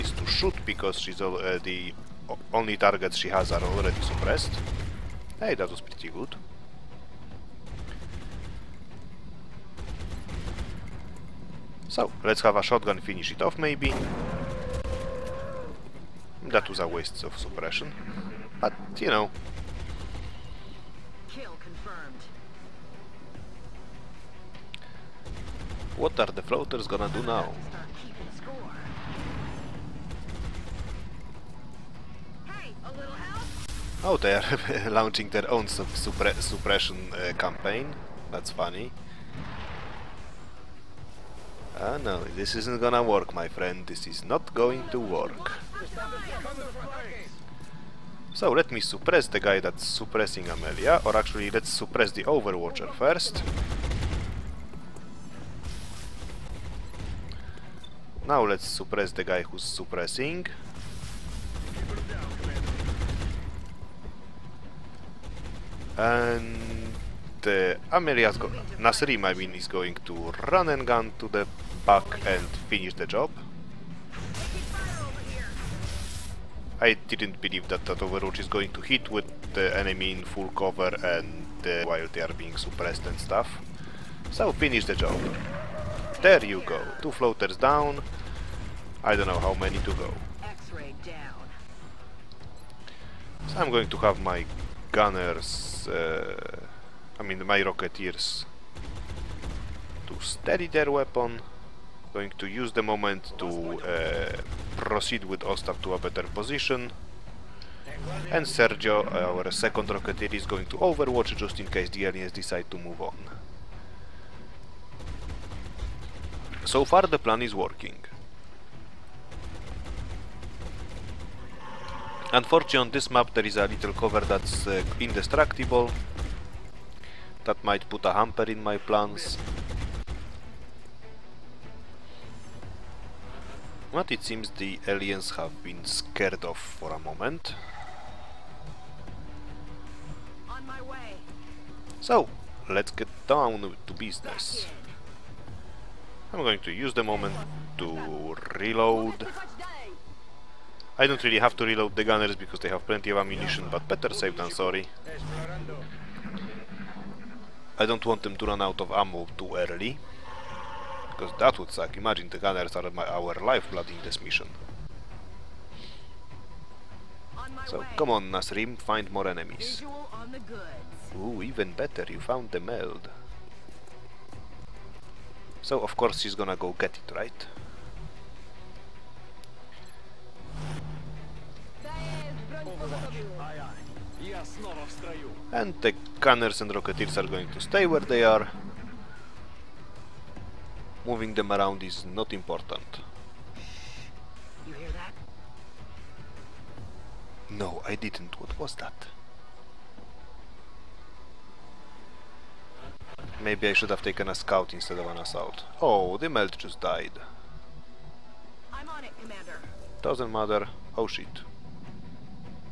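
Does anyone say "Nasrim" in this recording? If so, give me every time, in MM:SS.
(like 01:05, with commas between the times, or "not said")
01:08, 02:48.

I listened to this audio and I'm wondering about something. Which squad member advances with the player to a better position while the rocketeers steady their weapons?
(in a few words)
Ostap.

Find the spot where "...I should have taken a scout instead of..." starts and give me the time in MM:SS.
03:23.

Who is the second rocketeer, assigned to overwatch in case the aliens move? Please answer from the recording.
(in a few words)
Sergio.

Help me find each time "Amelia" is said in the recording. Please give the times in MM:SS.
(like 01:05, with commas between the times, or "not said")
00:50, 01:07.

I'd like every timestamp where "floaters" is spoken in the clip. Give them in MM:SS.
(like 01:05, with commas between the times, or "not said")
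00:26, 01:27.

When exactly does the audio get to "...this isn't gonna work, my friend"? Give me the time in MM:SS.
00:42.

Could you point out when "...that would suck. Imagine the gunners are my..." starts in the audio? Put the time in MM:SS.
02:41.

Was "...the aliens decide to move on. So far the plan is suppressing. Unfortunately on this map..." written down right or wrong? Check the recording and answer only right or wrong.
wrong.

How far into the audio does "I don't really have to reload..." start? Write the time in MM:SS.
02:30.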